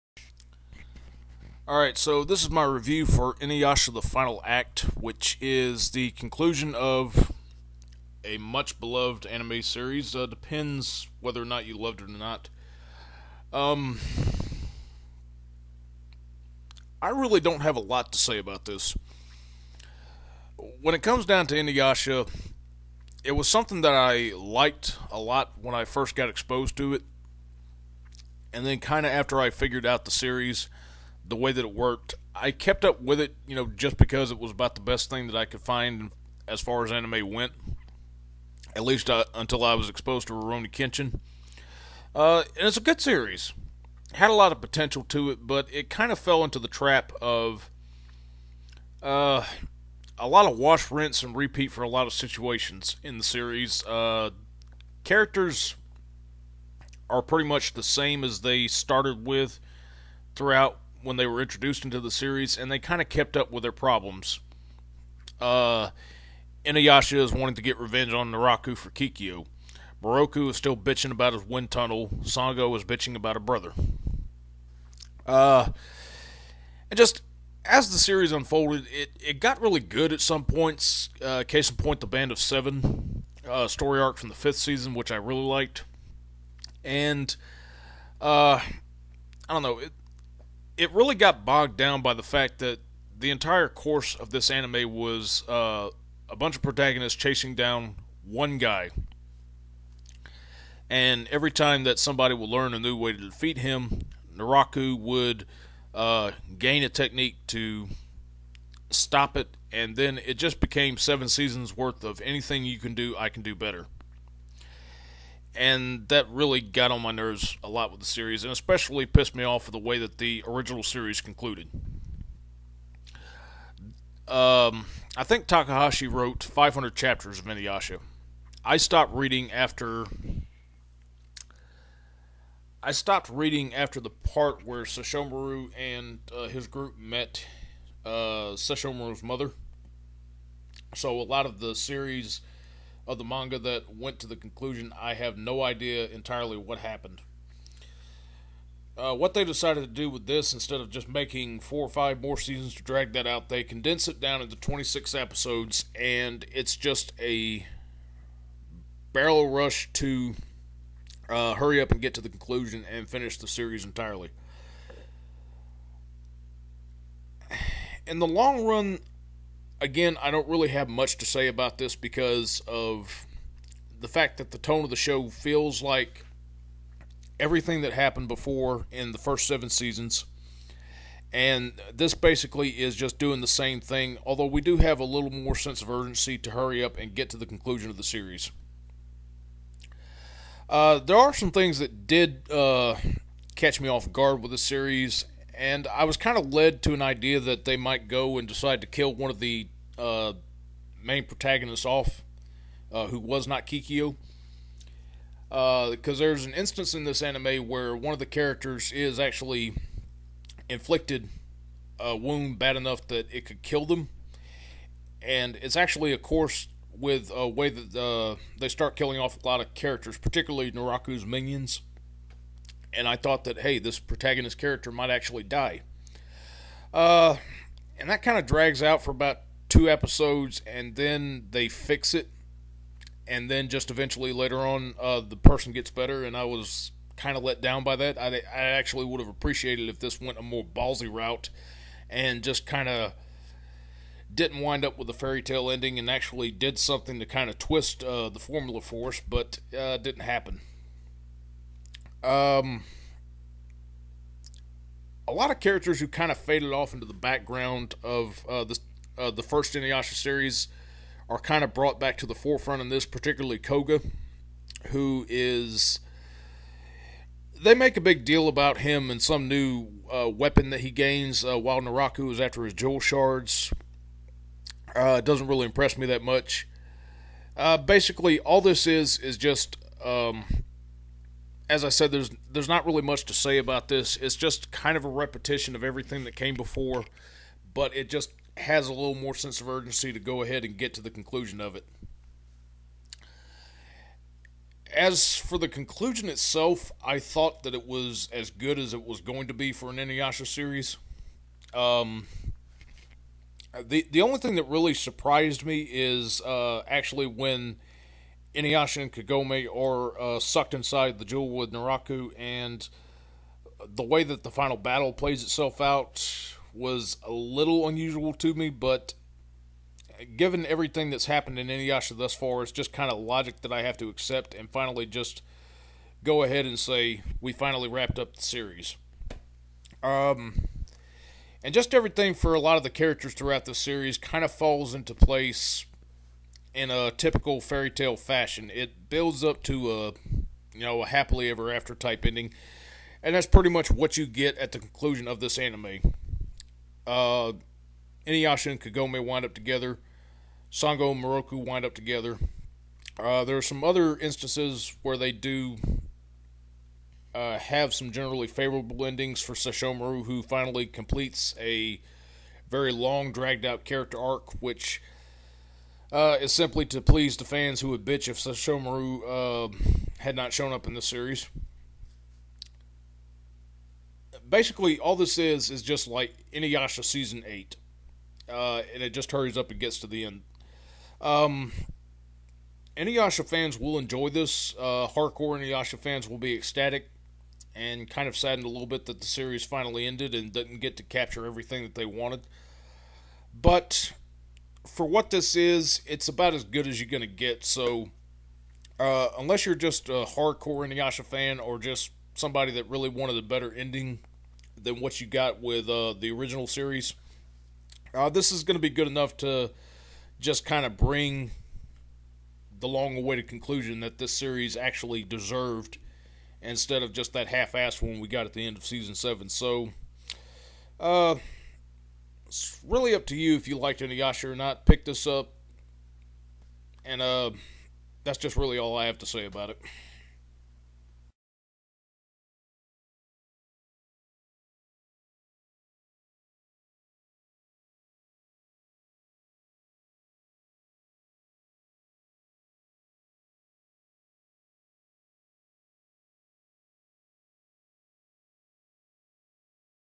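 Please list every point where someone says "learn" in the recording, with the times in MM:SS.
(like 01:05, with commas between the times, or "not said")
01:42.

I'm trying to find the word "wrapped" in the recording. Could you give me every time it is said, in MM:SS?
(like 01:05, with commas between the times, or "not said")
05:27.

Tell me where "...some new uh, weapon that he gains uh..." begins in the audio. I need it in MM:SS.
04:29.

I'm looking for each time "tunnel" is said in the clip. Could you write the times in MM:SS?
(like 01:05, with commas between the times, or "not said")
01:11.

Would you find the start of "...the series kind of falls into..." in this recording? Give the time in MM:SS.
05:33.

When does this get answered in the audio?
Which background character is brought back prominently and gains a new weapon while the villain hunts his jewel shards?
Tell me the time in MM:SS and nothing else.
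04:23.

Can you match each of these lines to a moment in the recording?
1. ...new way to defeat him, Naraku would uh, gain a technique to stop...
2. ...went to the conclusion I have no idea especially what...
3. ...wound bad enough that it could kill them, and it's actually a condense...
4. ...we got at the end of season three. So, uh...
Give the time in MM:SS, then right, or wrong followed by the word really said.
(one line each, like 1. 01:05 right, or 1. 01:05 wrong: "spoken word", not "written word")
1. 01:42 right
2. 02:23 wrong: "entirely", not "especially"
3. 03:32 wrong: "course", not "condense"
4. 06:58 wrong: "seven", not "three".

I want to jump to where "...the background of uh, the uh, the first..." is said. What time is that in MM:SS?
04:17.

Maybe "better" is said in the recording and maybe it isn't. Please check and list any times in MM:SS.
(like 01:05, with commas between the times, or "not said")
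01:53, 03:55, 06:43.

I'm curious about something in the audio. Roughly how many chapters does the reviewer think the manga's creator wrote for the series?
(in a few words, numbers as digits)
500.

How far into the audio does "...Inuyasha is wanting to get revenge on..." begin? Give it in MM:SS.
01:06.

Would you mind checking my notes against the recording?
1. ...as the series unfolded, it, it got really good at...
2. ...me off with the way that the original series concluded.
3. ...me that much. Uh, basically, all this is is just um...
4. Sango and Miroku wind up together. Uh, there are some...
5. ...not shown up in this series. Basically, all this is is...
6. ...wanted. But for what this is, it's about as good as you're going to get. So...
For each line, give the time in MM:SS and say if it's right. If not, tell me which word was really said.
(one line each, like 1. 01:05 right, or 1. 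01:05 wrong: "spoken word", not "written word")
1. 01:17 right
2. 01:59 right
3. 04:35 right
4. 05:50 right
5. 06:10 right
6. 06:32 right.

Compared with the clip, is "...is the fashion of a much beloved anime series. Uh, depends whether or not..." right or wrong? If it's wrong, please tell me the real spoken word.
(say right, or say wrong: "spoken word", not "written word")
wrong: "conclusion", not "fashion".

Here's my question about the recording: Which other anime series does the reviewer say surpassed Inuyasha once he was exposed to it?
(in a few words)
Rurouni Kenshin.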